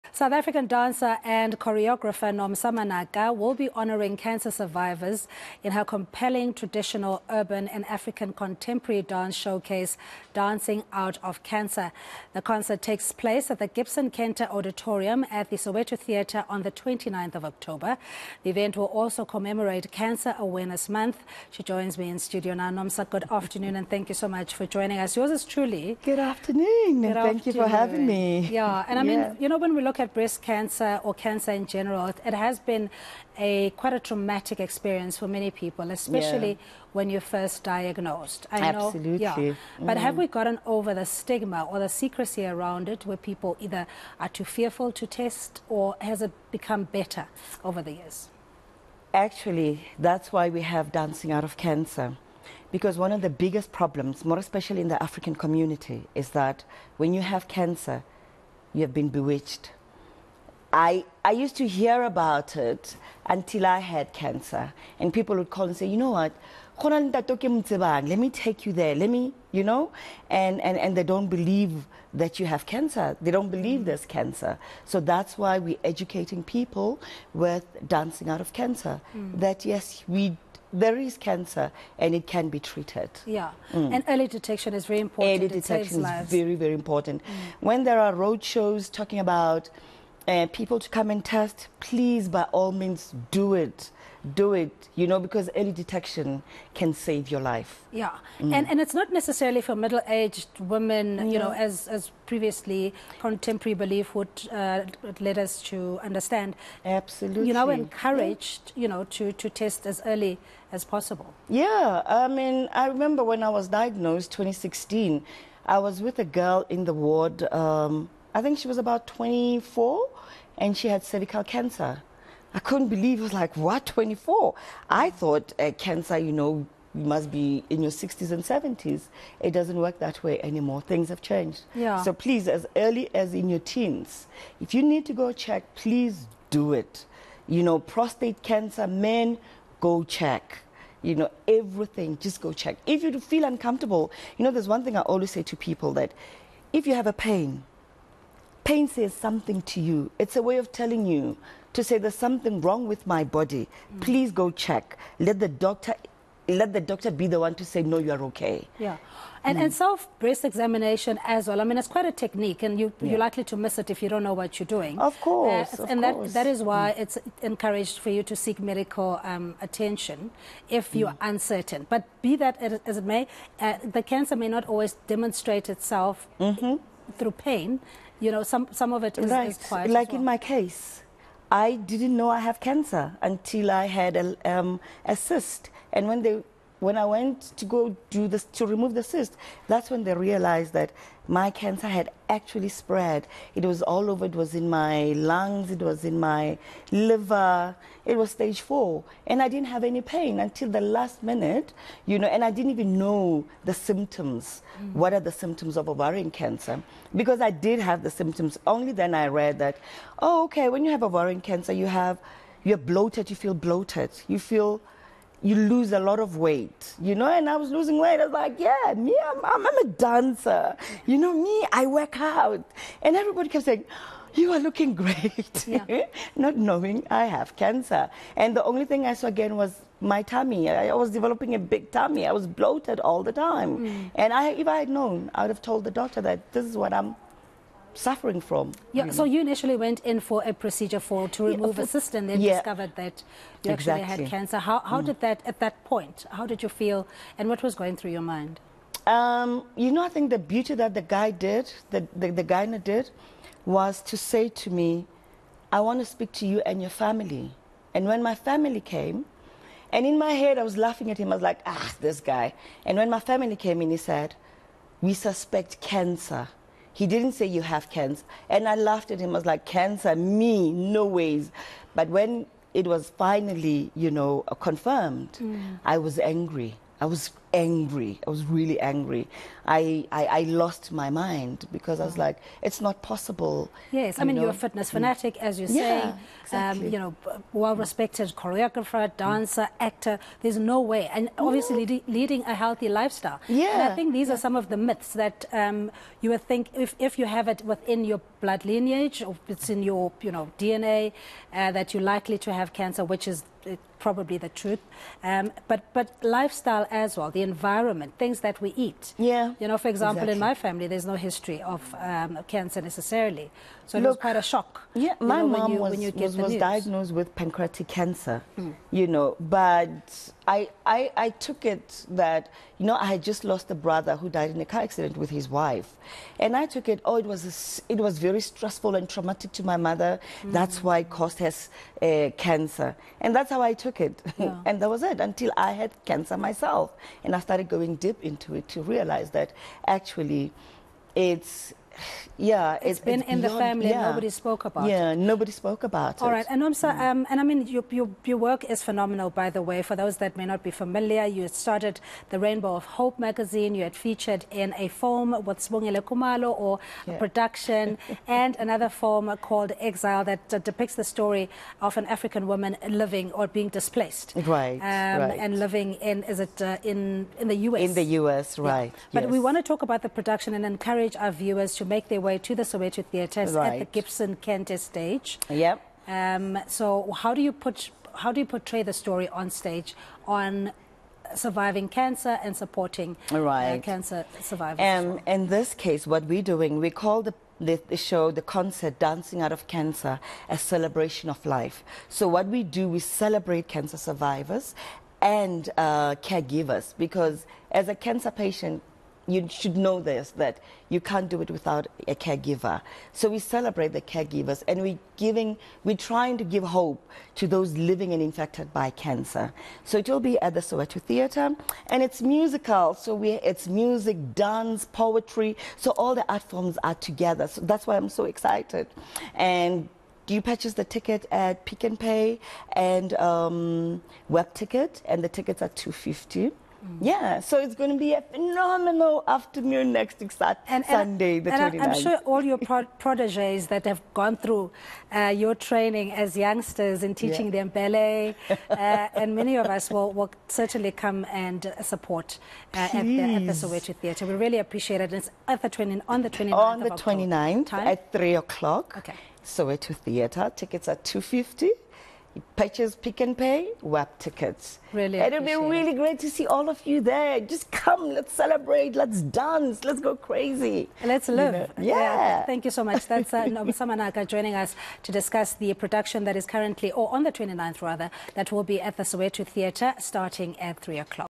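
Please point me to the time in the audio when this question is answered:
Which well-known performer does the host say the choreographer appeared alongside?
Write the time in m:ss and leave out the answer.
5:55.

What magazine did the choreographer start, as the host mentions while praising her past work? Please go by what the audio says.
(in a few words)
Rainbow of Hope.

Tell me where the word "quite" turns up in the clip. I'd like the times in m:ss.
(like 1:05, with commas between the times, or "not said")
0:33, 2:41, 5:14.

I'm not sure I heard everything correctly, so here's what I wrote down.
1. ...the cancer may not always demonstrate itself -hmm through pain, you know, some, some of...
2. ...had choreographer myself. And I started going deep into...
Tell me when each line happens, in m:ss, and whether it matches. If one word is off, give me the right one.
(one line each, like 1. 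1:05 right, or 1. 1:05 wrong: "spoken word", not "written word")
1. 2:53 right
2. 5:35 wrong: "cancer", not "choreographer".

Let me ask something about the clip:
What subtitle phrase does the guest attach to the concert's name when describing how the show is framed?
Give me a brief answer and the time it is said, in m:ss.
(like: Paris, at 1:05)
A celebration of life, at 6:30.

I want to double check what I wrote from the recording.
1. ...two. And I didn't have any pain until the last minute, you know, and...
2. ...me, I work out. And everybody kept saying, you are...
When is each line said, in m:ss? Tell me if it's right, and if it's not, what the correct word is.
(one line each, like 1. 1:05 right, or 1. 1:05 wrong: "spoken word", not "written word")
1. 3:18 wrong: "four", not "two"
2. 3:41 right.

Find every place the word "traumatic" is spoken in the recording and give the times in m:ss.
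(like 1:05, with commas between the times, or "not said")
0:33, 5:29.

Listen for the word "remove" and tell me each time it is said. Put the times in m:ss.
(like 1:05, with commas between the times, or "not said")
3:08, 4:01.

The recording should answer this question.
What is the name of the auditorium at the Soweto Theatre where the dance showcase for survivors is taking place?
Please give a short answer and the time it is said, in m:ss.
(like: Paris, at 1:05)
Gibson Kente Auditorium, at 0:13.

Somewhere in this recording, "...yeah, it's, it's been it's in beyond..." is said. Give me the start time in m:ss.
5:42.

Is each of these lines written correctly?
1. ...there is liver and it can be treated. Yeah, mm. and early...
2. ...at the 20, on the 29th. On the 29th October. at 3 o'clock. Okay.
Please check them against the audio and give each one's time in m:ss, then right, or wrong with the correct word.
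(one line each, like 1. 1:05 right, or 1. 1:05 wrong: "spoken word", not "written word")
1. 1:20 wrong: "cancer", not "liver"
2. 7:25 right.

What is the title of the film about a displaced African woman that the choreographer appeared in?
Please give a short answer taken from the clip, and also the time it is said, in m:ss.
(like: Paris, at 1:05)
Exile, at 5:59.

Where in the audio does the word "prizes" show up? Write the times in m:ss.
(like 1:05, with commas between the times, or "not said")
not said.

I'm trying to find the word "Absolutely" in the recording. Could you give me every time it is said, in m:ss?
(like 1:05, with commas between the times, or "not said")
0:38, 1:46.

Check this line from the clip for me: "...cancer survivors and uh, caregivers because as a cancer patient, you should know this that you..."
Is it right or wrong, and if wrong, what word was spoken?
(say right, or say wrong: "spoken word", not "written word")
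right.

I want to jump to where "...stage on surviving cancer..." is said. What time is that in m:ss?
6:19.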